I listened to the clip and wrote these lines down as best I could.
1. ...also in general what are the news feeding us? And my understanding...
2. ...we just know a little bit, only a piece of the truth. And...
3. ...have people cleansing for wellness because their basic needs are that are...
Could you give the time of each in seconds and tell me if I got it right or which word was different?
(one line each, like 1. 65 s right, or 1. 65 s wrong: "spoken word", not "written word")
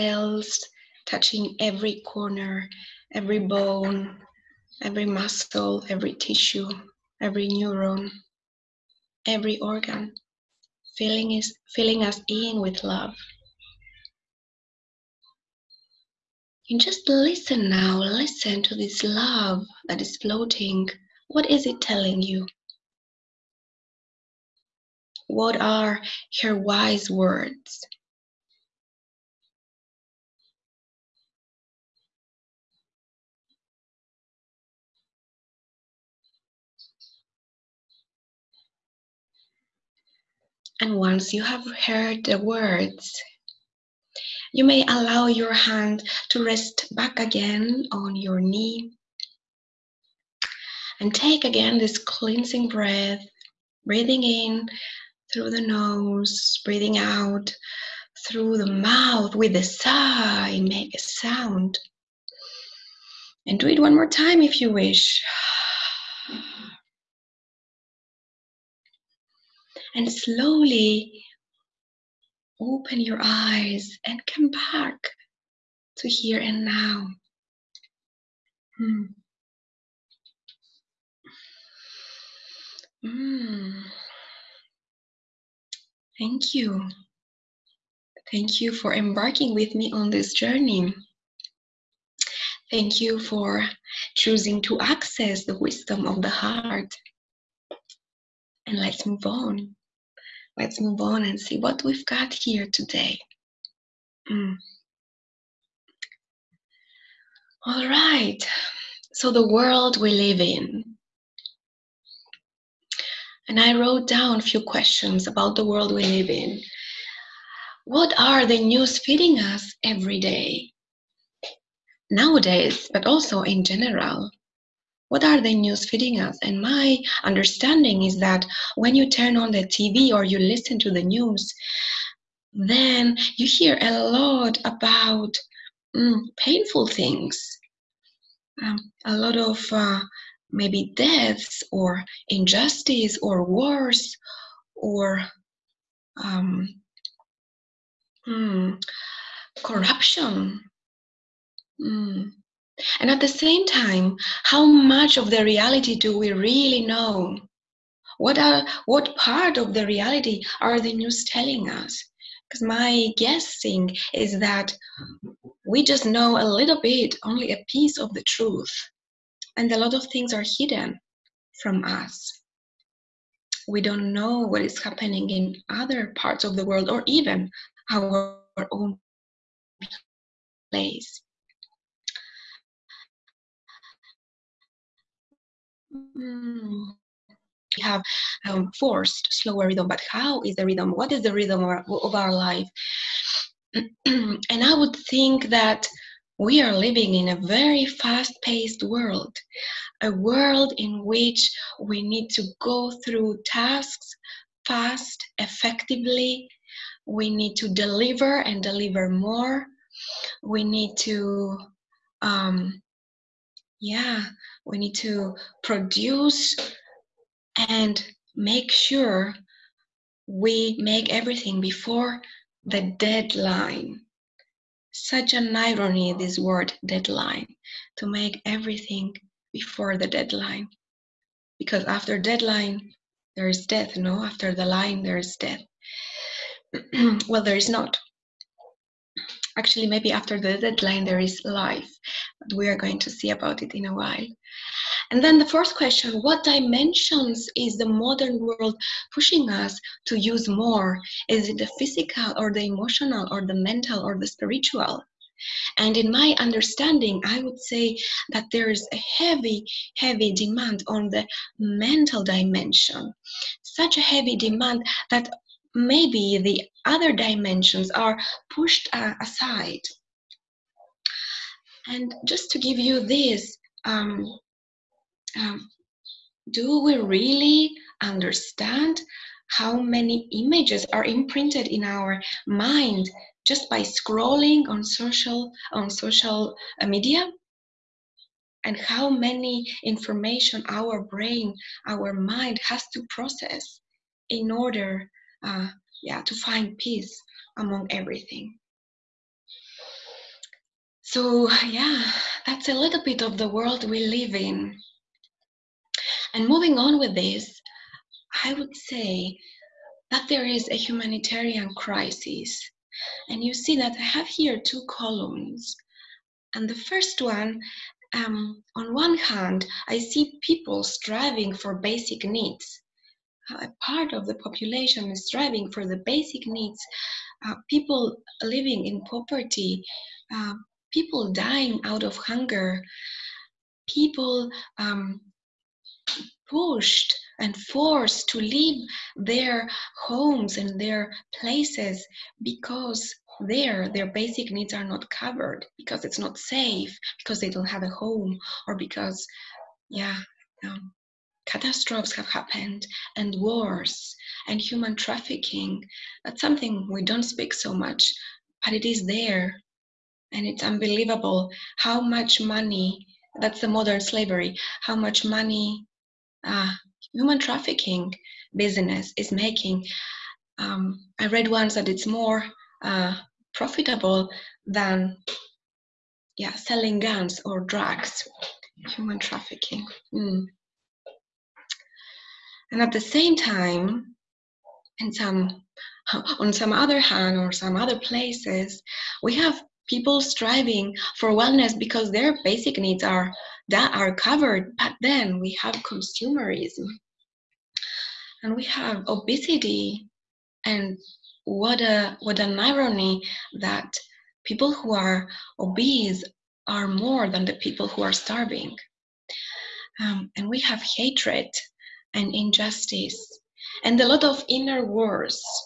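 1. 123 s right
2. 165 s right
3. 389 s wrong: "striving", not "cleansing".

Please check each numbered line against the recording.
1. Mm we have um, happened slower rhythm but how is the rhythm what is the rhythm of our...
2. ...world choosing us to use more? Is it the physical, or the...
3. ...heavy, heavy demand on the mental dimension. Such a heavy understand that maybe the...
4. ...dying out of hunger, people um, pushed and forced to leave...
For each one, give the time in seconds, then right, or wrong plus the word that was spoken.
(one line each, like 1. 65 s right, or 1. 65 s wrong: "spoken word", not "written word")
1. 185 s wrong: "forced", not "happened"
2. 248 s wrong: "pushing", not "choosing"
3. 259 s wrong: "demand", not "understand"
4. 331 s right.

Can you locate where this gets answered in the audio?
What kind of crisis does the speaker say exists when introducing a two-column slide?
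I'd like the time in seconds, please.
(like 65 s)
310 s.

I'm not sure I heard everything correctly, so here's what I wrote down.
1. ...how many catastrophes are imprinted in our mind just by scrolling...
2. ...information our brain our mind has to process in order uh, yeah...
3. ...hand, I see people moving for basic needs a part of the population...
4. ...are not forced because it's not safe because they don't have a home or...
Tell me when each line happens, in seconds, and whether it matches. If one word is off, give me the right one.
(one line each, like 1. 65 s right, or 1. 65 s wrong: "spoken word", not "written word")
1. 279 s wrong: "images", not "catastrophes"
2. 289 s right
3. 319 s wrong: "striving", not "moving"
4. 344 s wrong: "covered", not "forced".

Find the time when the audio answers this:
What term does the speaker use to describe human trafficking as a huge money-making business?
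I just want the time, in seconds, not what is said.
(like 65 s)
363 s.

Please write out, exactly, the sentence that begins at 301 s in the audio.
So yeah, that's a little bit of the world we live in.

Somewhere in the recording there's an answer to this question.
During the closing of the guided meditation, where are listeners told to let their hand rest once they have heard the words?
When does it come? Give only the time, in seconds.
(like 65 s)
47 s.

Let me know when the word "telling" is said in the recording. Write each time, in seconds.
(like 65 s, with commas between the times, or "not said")
21 s, 161 s.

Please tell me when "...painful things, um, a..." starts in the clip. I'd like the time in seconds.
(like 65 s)
136 s.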